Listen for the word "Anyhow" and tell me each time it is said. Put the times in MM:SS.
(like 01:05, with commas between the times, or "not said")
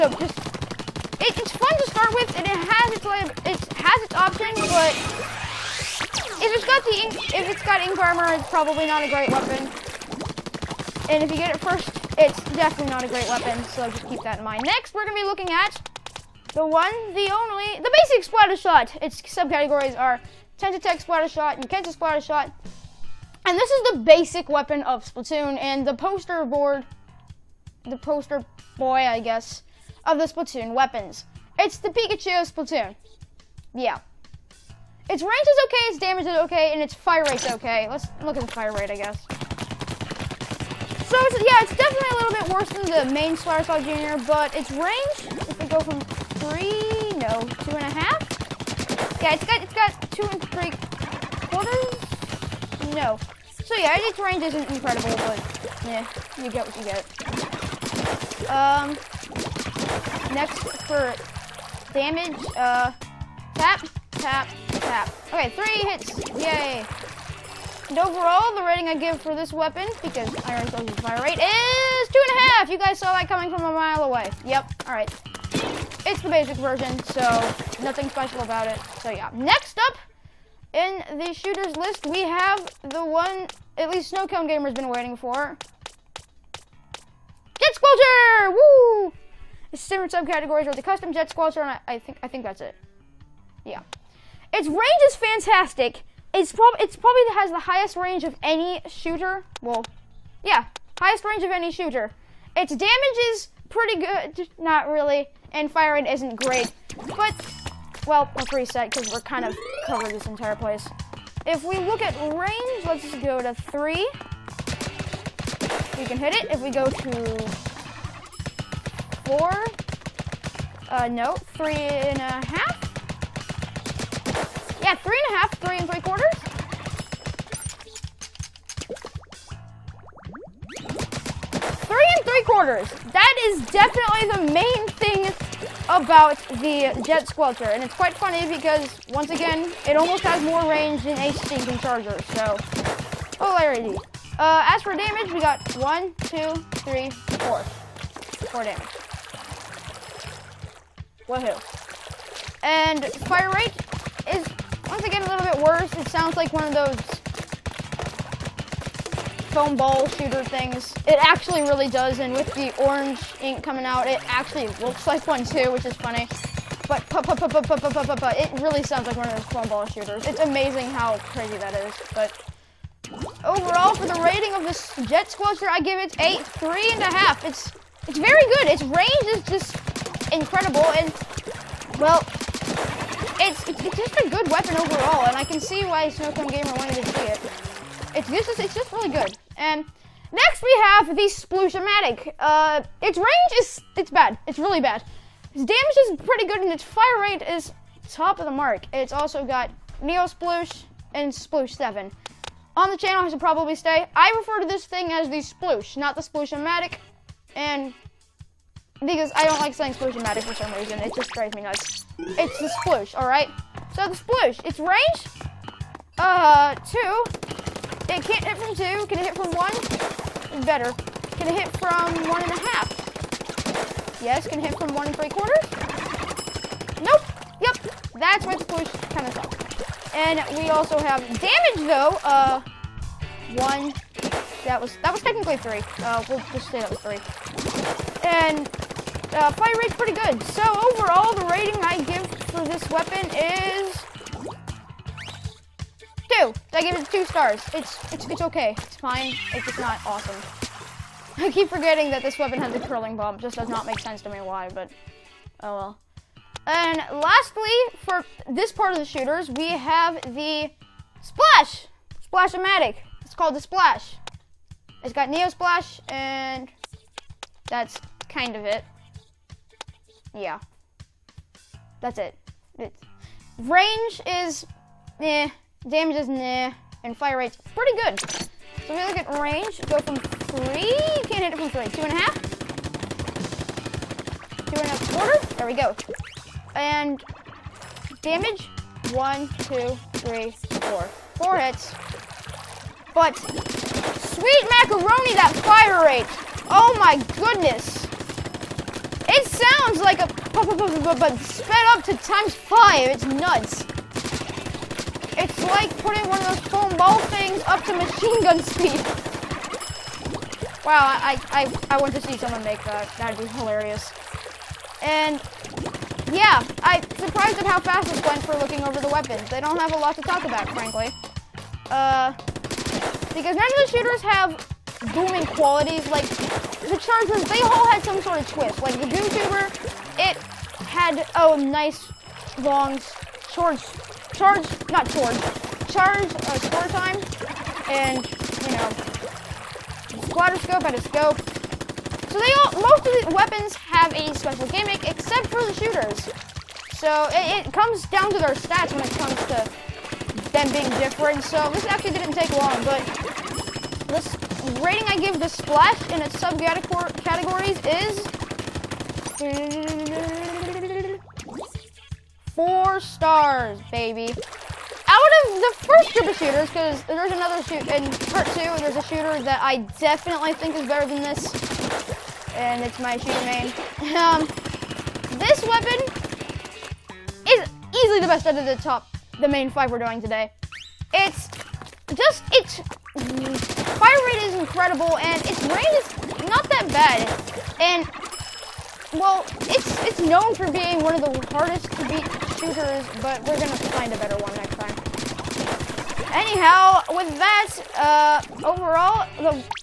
06:36.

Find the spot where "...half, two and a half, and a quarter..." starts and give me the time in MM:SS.
04:42.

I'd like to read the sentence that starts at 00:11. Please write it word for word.
And if you get it first, it's definitely not a great weapon, so just keep that in mind.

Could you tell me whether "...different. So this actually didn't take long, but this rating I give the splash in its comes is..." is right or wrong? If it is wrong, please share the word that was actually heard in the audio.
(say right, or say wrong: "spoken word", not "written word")
wrong: "subcategories", not "comes".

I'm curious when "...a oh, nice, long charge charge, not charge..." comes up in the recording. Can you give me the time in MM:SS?
05:31.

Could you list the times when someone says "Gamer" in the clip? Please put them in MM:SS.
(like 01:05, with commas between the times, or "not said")
01:24, 03:06.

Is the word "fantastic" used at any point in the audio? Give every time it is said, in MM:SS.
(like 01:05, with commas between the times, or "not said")
01:35.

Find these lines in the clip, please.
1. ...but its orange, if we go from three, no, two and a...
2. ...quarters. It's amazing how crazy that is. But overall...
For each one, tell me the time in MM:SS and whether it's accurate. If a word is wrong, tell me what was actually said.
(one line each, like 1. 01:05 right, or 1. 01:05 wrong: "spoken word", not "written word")
1. 00:44 wrong: "range", not "orange"
2. 02:49 wrong: "shooters", not "quarters".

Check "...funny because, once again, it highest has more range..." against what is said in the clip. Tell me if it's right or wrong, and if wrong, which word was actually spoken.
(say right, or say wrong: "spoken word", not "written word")
wrong: "almost", not "highest".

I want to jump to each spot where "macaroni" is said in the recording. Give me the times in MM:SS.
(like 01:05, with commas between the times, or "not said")
04:54.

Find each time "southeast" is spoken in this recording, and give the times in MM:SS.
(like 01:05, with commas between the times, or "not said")
not said.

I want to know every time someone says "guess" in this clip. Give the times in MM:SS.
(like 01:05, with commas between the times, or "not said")
00:29, 00:38.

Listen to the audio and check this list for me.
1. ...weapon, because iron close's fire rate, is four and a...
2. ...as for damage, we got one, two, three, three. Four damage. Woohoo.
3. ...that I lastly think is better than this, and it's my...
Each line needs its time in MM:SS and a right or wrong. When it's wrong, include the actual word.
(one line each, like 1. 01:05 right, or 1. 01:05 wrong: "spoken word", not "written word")
1. 01:09 wrong: "two", not "four"
2. 02:24 wrong: "four", not "three"
3. 06:09 wrong: "definitely", not "lastly".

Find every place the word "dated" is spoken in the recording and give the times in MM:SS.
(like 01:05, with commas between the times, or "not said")
not said.